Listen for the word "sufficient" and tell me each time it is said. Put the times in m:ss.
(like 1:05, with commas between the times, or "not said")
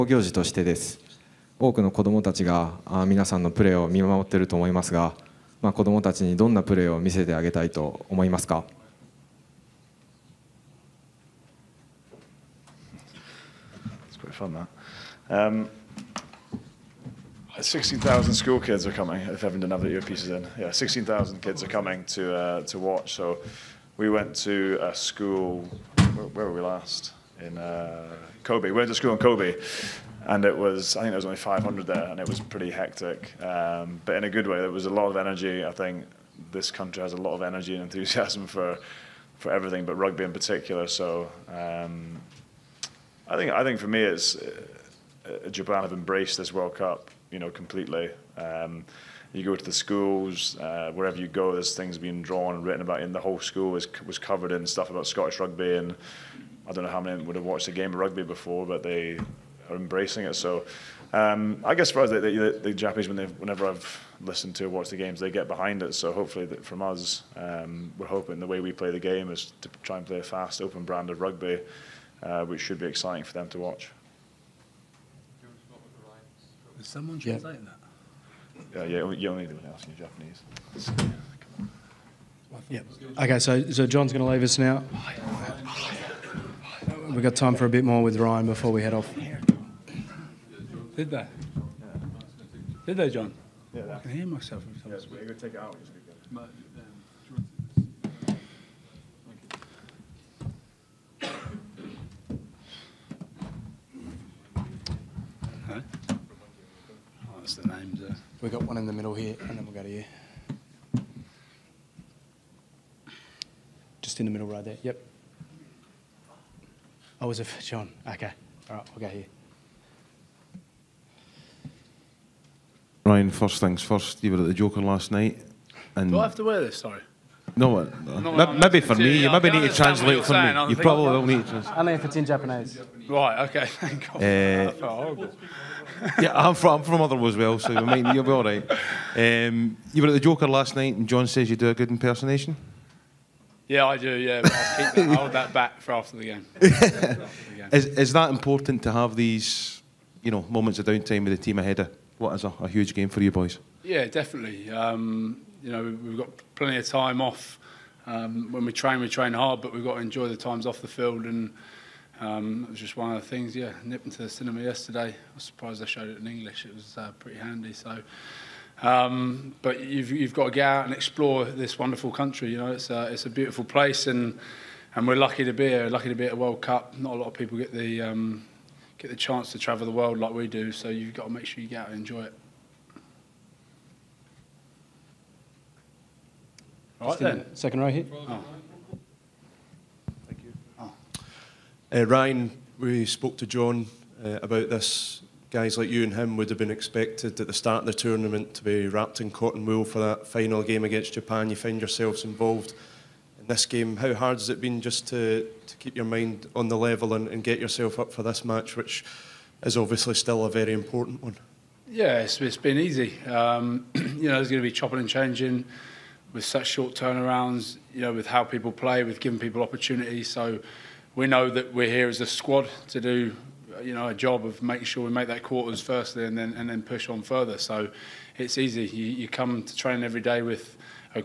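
not said.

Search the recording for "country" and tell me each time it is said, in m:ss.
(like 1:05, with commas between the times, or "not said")
0:36, 2:52.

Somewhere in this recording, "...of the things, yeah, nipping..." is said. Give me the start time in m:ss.
2:43.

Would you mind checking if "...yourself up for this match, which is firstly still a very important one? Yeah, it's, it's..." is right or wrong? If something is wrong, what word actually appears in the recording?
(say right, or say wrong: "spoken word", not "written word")
wrong: "obviously", not "firstly".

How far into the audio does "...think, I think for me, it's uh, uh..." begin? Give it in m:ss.
0:43.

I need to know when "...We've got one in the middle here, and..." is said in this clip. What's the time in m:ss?
1:48.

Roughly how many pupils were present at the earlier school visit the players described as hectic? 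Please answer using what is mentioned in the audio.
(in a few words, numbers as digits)
500.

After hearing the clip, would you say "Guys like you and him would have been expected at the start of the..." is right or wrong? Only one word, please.
right.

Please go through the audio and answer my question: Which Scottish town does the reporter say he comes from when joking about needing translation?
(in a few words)
Motherwell.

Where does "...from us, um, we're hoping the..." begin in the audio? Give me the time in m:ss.
1:06.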